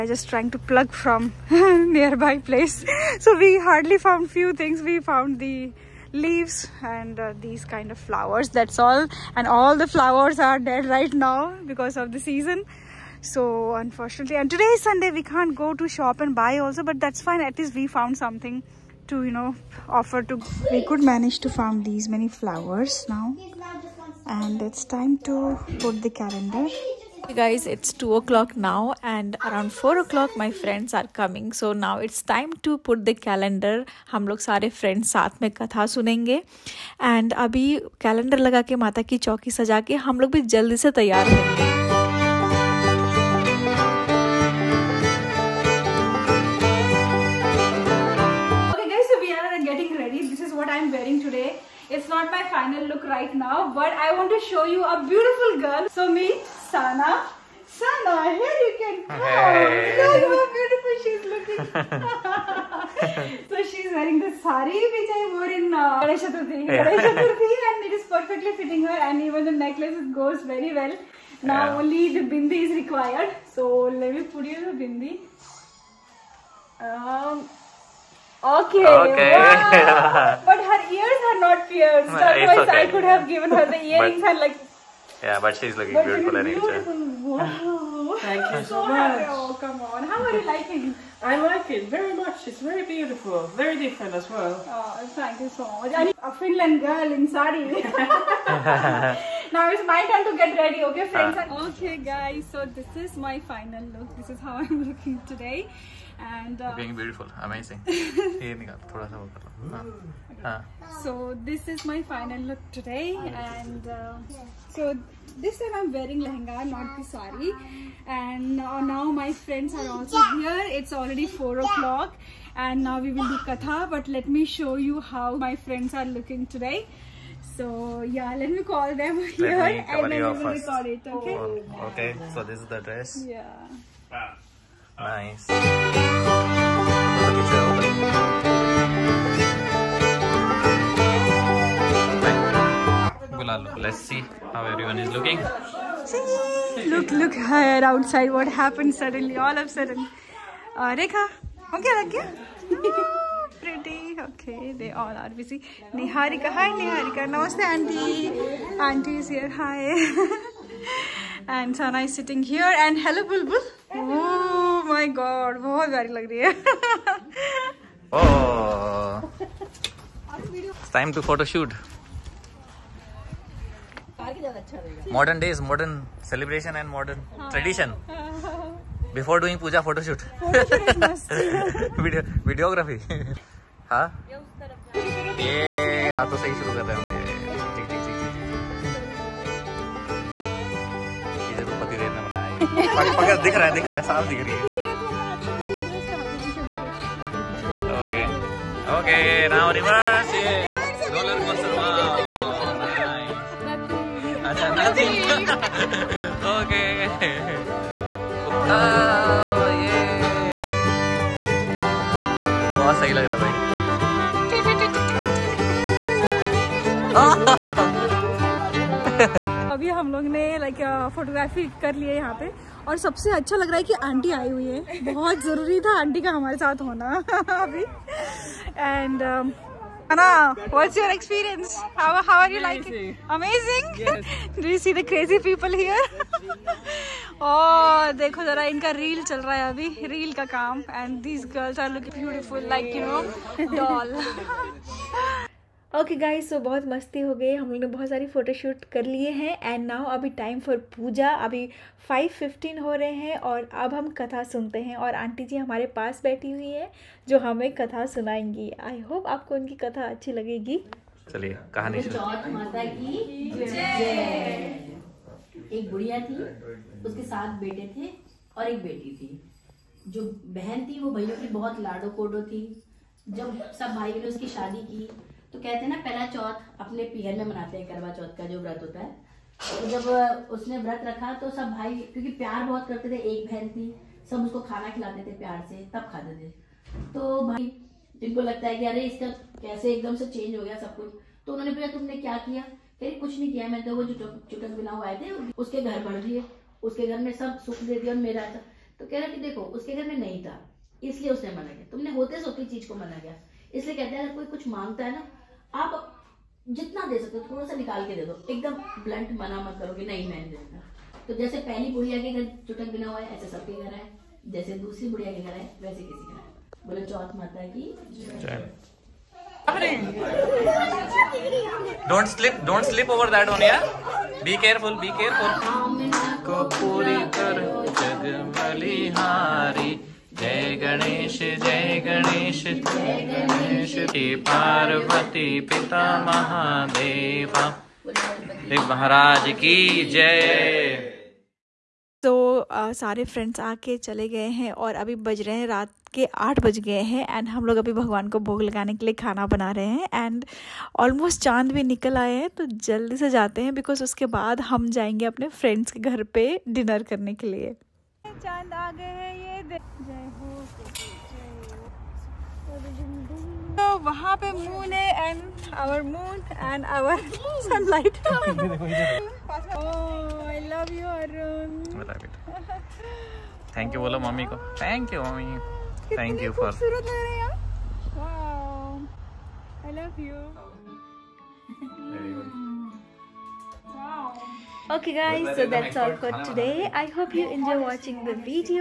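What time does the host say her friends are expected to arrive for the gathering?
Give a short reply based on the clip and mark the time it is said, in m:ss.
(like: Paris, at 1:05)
4 o'clock, at 0:29.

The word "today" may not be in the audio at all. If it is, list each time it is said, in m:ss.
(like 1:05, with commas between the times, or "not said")
0:14, 1:45, 1:52, 2:06, 6:26.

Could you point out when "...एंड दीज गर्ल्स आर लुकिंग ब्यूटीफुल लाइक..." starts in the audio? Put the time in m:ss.
4:00.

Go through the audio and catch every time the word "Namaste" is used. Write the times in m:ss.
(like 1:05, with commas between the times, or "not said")
2:37.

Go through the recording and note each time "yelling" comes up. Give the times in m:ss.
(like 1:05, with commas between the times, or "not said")
not said.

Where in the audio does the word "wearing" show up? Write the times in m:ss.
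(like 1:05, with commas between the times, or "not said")
1:03, 1:55.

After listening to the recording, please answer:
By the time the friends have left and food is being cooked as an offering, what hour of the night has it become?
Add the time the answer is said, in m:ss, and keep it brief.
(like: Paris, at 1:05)
8 o'clock, at 5:45.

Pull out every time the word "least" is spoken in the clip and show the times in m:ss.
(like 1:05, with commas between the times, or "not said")
0:17.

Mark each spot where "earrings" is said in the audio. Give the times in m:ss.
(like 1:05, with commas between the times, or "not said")
1:23.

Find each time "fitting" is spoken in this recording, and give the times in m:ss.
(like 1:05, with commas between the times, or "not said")
1:08.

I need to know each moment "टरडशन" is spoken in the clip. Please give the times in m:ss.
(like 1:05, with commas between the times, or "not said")
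2:57.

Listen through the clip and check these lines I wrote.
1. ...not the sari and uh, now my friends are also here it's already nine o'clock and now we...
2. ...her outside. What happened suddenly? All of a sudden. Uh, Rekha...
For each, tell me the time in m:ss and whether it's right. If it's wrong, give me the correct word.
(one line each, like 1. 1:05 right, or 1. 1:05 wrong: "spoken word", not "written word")
1. 1:56 wrong: "four", not "nine"
2. 2:27 right.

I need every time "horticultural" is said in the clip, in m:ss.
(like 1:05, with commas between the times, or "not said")
not said.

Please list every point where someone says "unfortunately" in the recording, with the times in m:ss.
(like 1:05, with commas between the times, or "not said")
0:13.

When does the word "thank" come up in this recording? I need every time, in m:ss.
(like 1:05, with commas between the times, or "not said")
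1:28, 1:35.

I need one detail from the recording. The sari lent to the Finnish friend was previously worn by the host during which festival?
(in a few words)
Ganesh Chaturthi.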